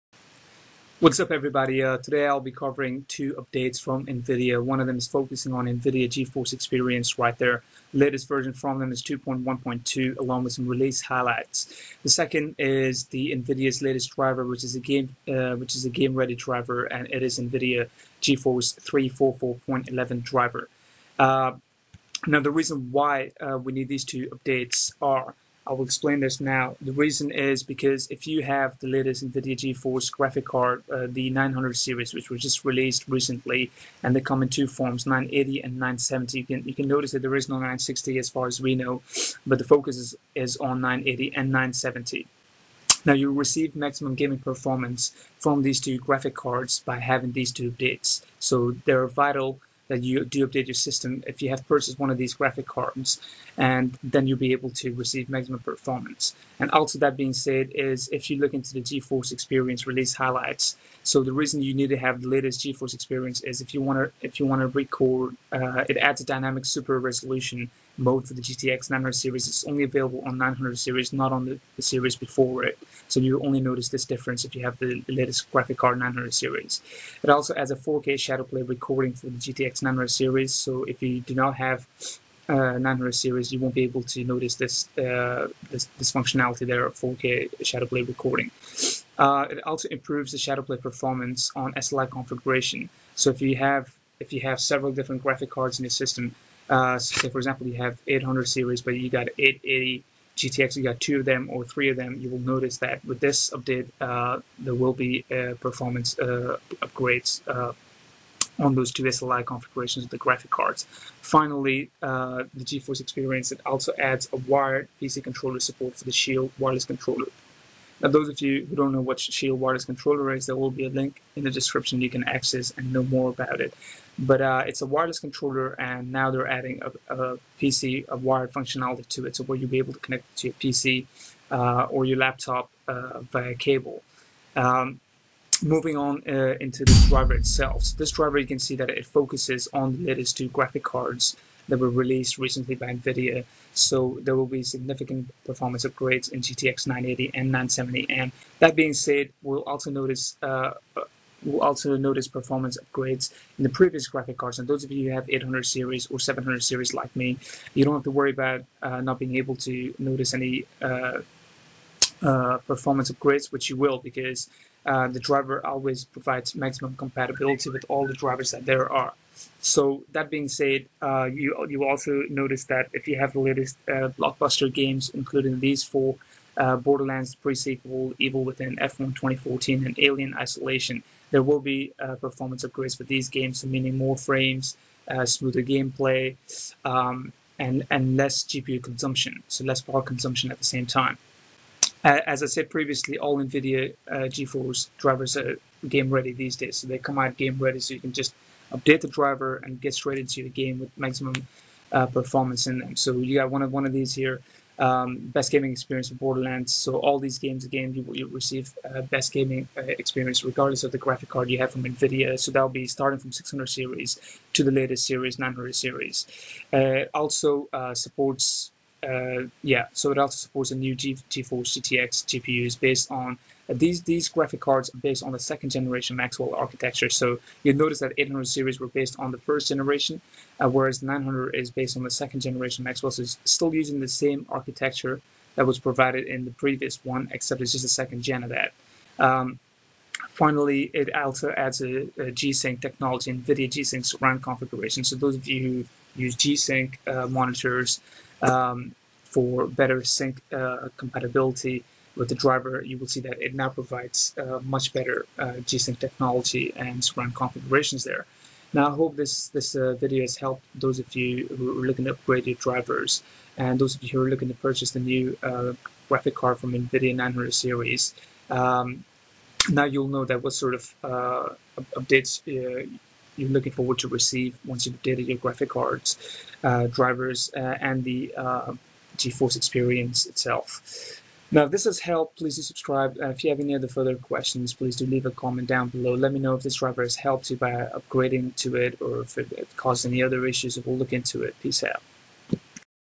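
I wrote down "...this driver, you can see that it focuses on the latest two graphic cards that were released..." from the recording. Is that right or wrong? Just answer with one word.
right.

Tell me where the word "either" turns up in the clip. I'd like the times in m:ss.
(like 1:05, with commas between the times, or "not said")
not said.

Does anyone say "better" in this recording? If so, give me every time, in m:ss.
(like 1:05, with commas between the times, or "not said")
4:09, 4:14.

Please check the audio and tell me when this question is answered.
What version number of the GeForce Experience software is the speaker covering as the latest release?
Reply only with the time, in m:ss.
0:09.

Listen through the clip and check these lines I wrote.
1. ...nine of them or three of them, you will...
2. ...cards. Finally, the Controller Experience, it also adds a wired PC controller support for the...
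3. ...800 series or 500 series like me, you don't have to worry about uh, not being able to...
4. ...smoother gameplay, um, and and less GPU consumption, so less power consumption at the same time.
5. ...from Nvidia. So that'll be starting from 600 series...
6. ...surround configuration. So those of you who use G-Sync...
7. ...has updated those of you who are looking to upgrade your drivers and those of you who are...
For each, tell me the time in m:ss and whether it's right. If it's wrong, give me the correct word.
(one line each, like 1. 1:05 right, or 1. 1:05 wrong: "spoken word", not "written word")
1. 1:41 wrong: "two", not "nine"
2. 1:50 wrong: "GeForce", not "Controller"
3. 2:35 wrong: "700", not "500"
4. 3:05 right
5. 3:31 right
6. 4:04 right
7. 4:20 wrong: "helped", not "updated".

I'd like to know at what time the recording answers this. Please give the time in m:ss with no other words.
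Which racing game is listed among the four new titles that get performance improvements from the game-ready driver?
2:58.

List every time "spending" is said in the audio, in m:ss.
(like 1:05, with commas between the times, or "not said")
not said.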